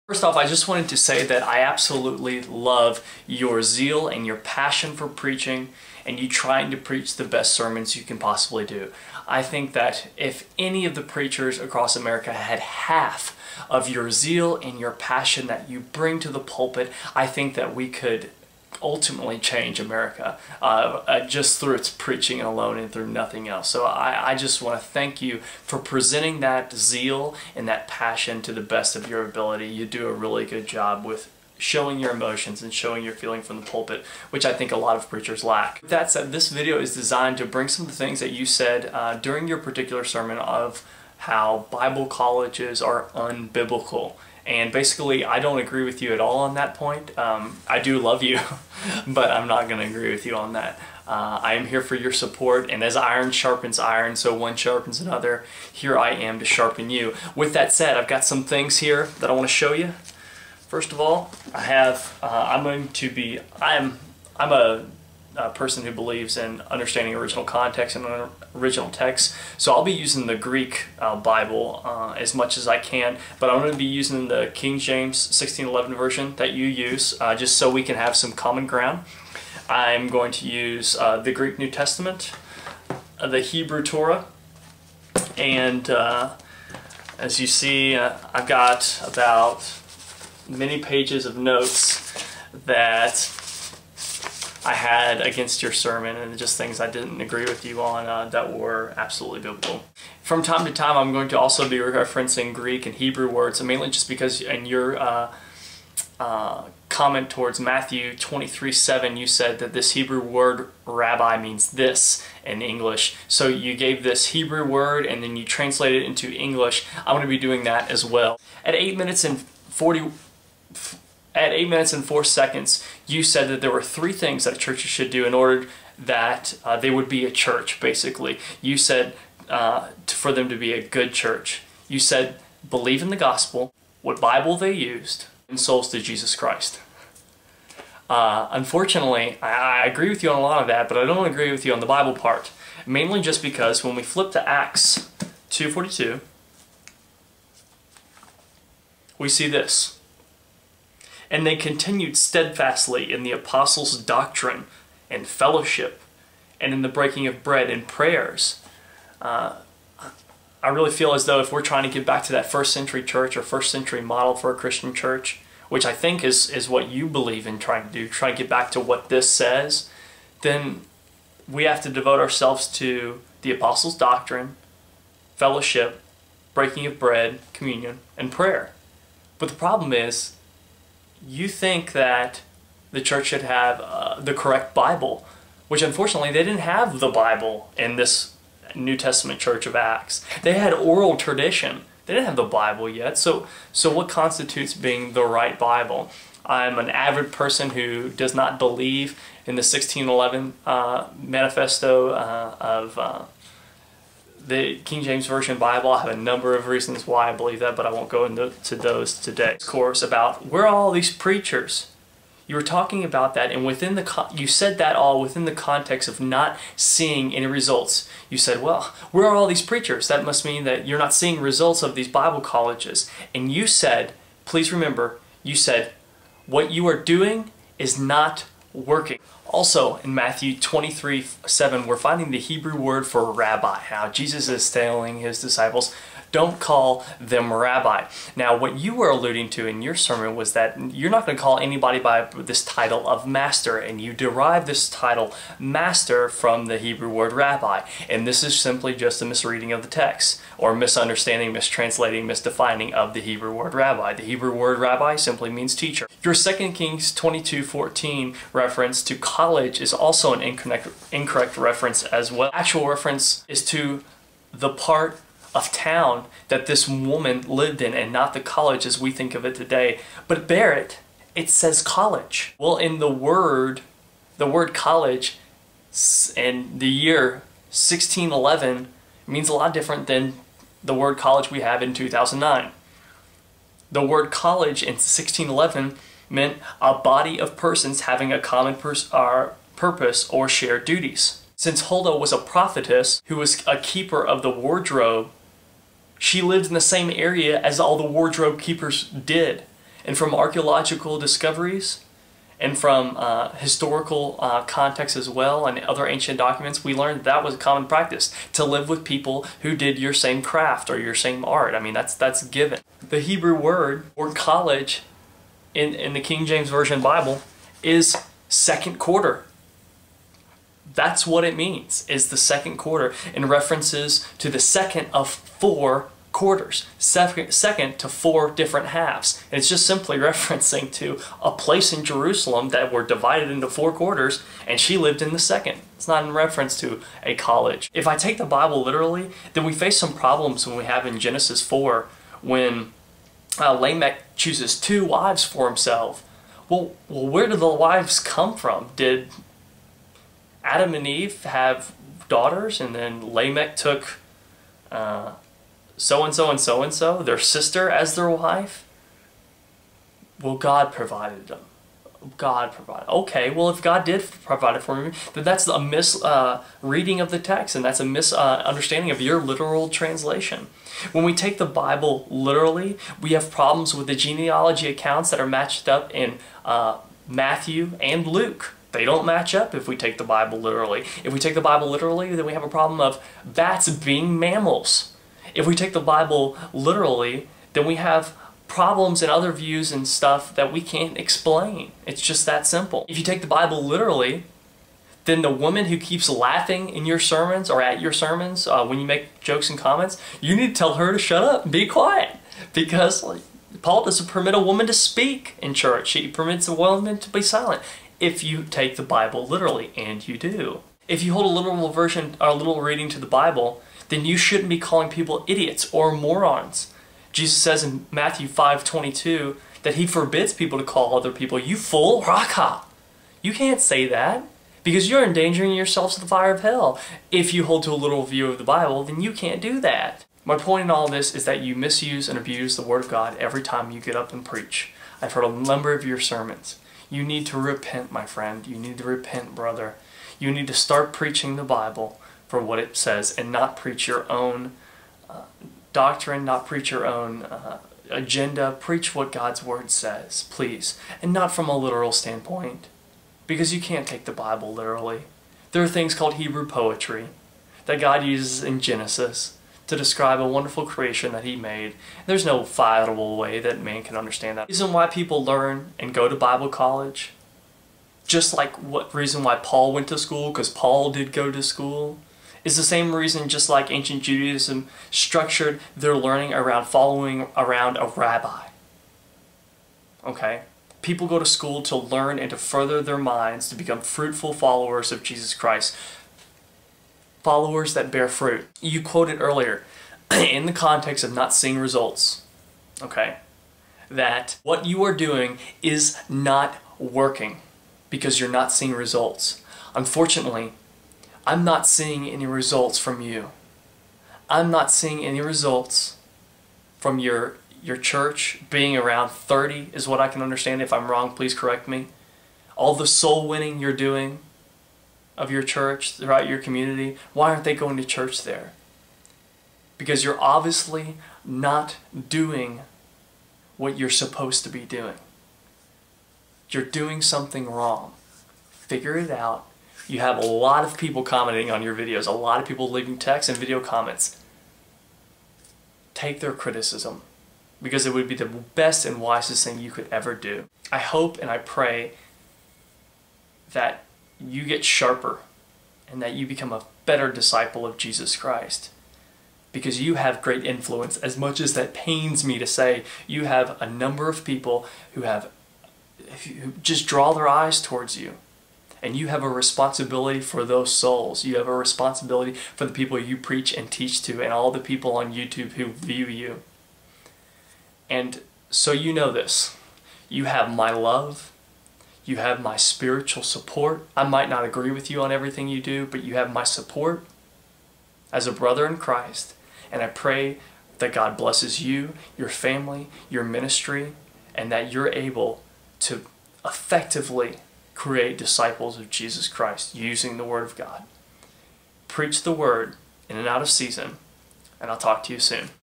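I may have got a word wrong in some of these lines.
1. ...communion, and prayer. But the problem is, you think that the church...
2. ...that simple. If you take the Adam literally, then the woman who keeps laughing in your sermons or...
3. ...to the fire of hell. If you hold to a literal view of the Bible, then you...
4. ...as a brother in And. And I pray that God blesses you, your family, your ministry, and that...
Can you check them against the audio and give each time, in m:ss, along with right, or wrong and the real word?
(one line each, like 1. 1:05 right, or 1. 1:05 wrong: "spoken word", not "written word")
1. 2:57 right
2. 6:32 wrong: "Bible", not "Adam"
3. 7:06 right
4. 9:38 wrong: "Christ", not "And".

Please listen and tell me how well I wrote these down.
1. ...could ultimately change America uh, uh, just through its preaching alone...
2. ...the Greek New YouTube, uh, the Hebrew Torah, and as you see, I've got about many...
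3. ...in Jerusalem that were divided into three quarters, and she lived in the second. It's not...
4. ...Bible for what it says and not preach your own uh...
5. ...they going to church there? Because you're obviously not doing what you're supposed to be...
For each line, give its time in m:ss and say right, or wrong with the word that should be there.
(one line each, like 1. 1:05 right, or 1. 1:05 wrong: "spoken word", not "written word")
1. 0:17 right
2. 1:21 wrong: "Testament", not "YouTube"
3. 5:31 wrong: "four", not "three"
4. 7:21 right
5. 8:37 right.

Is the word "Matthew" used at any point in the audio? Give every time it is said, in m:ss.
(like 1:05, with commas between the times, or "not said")
1:47, 3:50, 6:17, 6:58.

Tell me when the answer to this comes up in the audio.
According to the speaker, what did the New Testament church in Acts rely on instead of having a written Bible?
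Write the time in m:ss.
3:10.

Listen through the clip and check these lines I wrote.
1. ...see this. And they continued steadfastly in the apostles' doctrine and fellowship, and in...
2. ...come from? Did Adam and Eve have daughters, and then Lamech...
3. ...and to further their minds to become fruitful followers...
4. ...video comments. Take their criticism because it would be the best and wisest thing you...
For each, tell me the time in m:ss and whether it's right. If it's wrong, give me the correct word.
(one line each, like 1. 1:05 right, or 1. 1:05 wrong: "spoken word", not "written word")
1. 2:29 right
2. 5:48 right
3. 8:02 right
4. 8:53 right.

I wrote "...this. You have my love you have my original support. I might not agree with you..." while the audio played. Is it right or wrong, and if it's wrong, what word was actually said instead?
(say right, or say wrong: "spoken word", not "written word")
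wrong: "spiritual", not "original".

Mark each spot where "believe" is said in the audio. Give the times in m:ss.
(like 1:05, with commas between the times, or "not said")
1:05, 2:12, 2:47, 3:18, 3:27.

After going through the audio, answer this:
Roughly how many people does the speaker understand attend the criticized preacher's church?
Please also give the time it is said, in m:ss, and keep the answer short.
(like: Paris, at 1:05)
30, at 8:28.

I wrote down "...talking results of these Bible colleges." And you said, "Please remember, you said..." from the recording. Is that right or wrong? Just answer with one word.
wrong.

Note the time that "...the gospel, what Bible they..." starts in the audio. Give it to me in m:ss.
2:13.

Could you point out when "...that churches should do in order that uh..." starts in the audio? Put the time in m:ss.
2:04.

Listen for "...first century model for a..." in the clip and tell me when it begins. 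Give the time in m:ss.
2:43.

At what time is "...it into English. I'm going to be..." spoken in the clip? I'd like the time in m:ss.
1:56.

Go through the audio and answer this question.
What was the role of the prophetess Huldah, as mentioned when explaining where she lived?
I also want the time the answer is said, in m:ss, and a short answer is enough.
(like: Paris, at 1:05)
Keeper of the wardrobe, at 4:53.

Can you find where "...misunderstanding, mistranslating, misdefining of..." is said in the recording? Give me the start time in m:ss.
4:10.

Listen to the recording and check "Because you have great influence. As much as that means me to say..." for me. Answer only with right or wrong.
wrong.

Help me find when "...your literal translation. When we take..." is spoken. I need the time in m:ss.
6:09.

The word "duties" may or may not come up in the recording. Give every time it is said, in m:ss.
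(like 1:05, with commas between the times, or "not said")
4:50.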